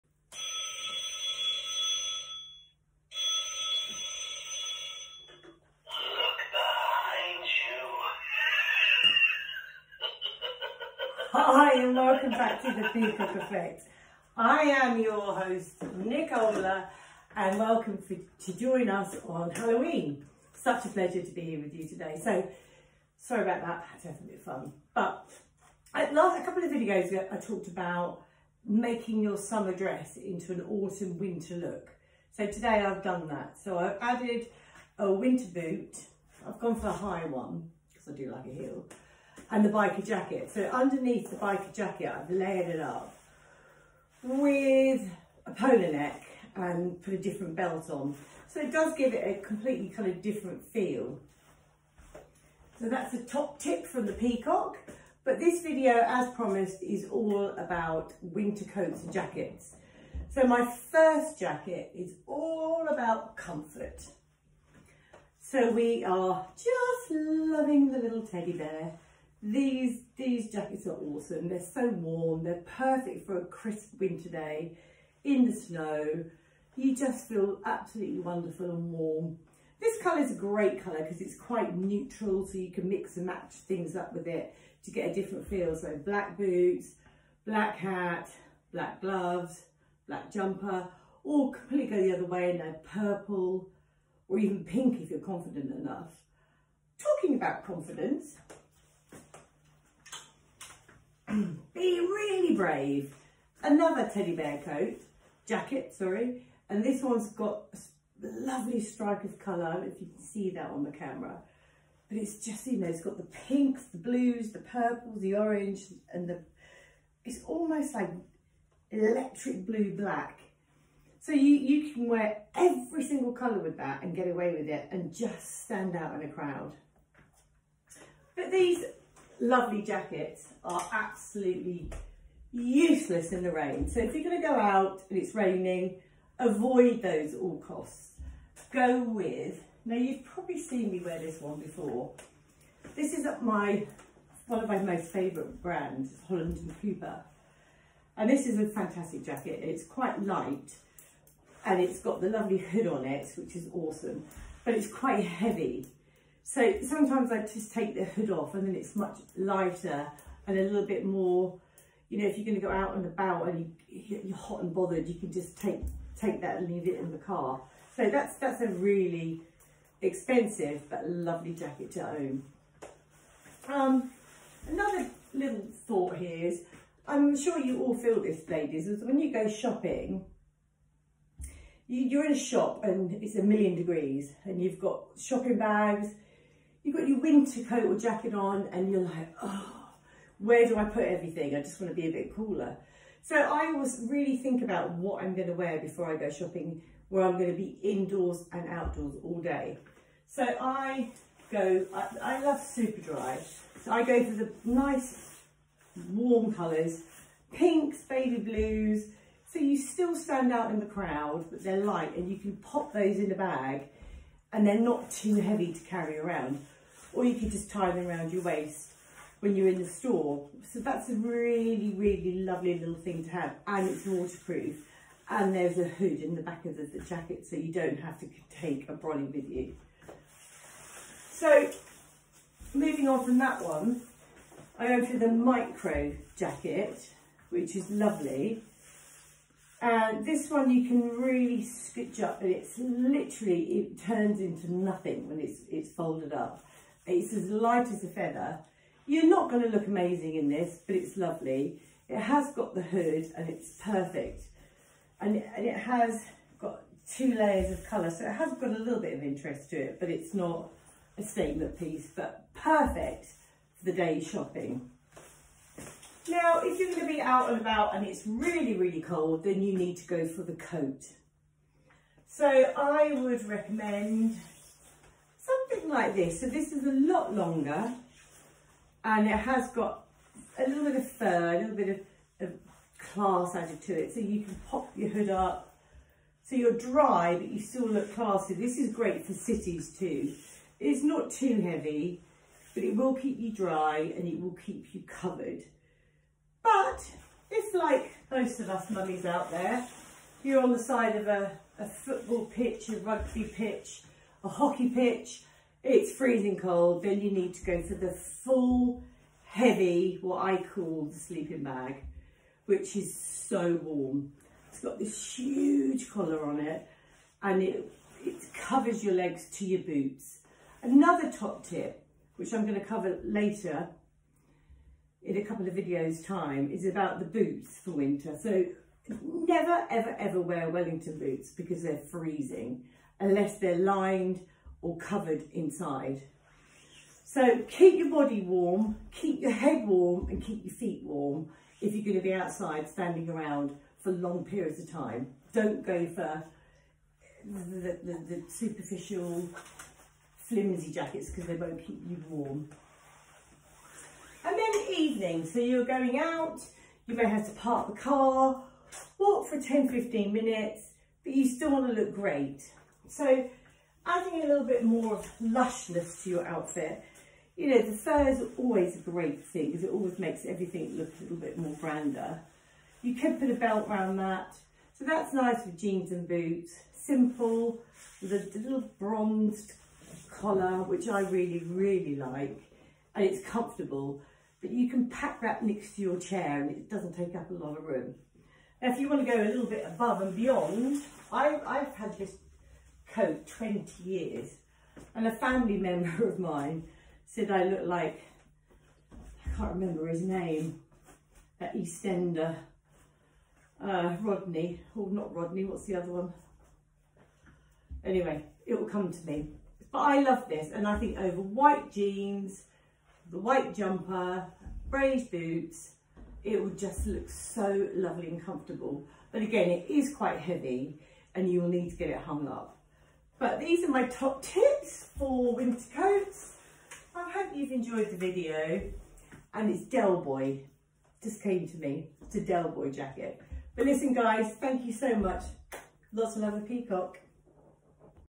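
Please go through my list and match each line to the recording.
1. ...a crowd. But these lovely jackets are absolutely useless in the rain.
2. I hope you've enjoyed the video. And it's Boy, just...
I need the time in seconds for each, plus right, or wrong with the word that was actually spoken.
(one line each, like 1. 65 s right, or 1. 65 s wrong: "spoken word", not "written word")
1. 126 s right
2. 427 s right.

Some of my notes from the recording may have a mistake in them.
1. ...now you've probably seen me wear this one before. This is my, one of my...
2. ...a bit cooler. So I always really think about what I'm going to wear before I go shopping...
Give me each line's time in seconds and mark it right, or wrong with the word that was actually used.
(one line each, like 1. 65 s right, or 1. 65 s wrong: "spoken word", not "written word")
1. 139 s right
2. 192 s right.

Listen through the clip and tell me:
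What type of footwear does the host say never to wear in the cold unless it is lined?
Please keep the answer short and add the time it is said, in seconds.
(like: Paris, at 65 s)
Wellington boots, at 330 s.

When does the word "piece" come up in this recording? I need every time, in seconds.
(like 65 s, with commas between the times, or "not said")
261 s.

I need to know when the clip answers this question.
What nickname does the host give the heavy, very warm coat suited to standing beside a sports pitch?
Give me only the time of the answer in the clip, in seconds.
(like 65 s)
311 s.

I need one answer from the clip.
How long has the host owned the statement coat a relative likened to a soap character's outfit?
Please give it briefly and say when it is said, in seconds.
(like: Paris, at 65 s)
20, at 393 s.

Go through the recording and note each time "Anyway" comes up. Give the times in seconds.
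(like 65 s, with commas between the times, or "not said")
408 s.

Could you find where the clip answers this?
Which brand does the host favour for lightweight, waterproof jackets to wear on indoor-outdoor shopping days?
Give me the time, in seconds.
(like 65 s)
202 s.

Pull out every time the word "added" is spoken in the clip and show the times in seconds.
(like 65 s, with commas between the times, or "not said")
34 s, 283 s.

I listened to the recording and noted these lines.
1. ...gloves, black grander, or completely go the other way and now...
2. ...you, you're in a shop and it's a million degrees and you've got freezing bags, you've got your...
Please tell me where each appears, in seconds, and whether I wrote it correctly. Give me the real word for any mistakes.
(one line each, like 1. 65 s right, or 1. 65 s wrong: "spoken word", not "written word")
1. 89 s wrong: "jumper", not "grander"
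2. 181 s wrong: "shopping", not "freezing".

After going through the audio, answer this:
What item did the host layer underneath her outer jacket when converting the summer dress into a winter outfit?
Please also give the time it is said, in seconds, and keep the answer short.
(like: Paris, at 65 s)
Polo neck, at 45 s.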